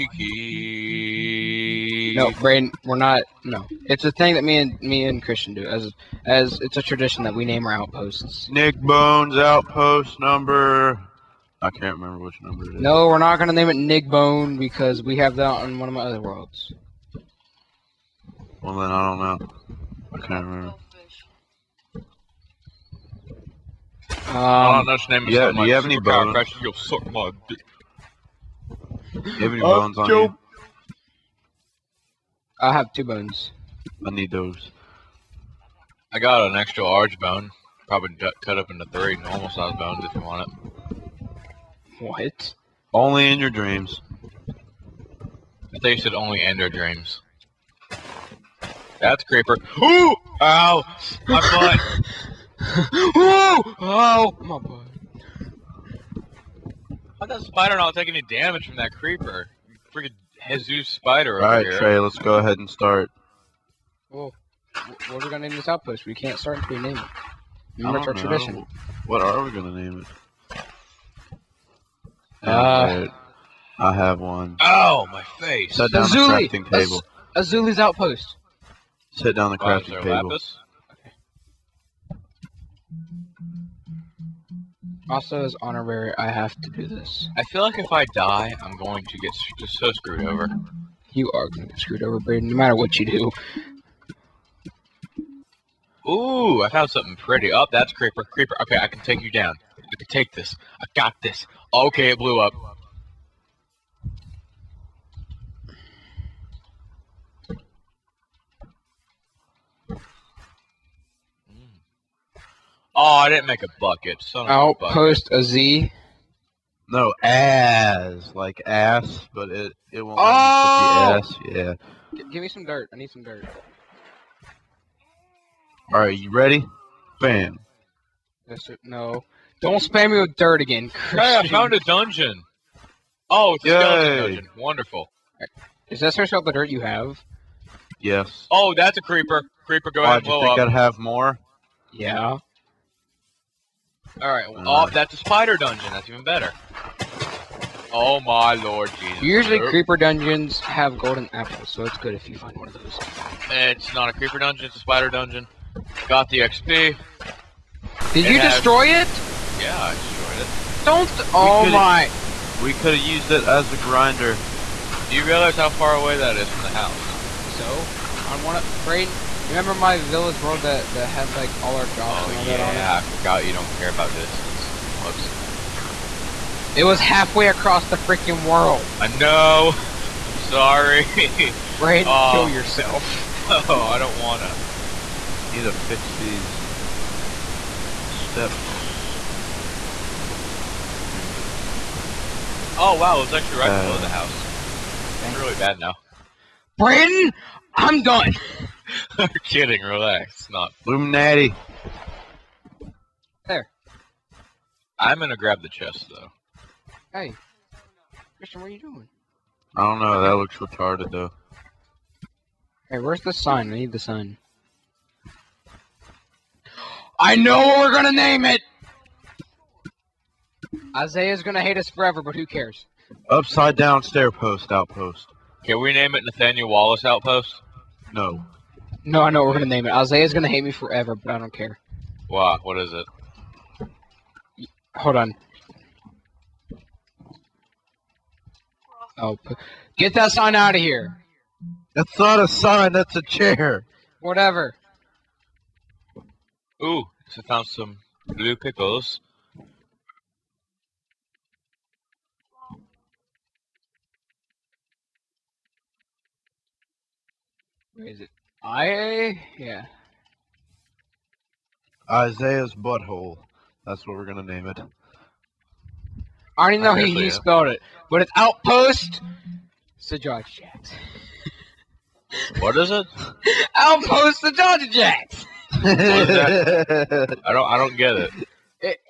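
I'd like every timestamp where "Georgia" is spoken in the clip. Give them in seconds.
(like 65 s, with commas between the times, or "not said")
270 s, 274 s.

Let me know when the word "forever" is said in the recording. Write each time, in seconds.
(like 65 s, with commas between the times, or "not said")
221 s, 230 s.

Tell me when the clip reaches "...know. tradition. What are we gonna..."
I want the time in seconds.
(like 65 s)
68 s.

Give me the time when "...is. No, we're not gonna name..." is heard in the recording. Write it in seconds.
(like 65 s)
12 s.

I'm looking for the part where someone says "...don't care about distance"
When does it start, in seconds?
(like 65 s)
173 s.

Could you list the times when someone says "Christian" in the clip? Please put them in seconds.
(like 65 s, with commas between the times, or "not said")
5 s, 130 s, 208 s.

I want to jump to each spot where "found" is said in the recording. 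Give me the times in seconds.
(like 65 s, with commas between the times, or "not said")
96 s, 131 s, 247 s.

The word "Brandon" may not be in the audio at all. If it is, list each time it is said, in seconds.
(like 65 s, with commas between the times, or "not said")
181 s, 196 s.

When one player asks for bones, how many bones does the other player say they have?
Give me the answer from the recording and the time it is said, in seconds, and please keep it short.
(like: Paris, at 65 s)
2, at 32 s.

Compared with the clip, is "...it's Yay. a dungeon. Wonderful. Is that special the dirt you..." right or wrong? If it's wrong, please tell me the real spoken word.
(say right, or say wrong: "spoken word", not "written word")
right.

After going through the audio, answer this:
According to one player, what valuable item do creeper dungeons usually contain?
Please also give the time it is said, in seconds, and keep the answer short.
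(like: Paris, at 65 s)
Golden apples, at 150 s.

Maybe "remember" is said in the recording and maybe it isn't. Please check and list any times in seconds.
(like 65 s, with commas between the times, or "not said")
11 s, 20 s, 67 s, 169 s.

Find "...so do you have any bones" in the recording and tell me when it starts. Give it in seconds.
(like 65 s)
25 s.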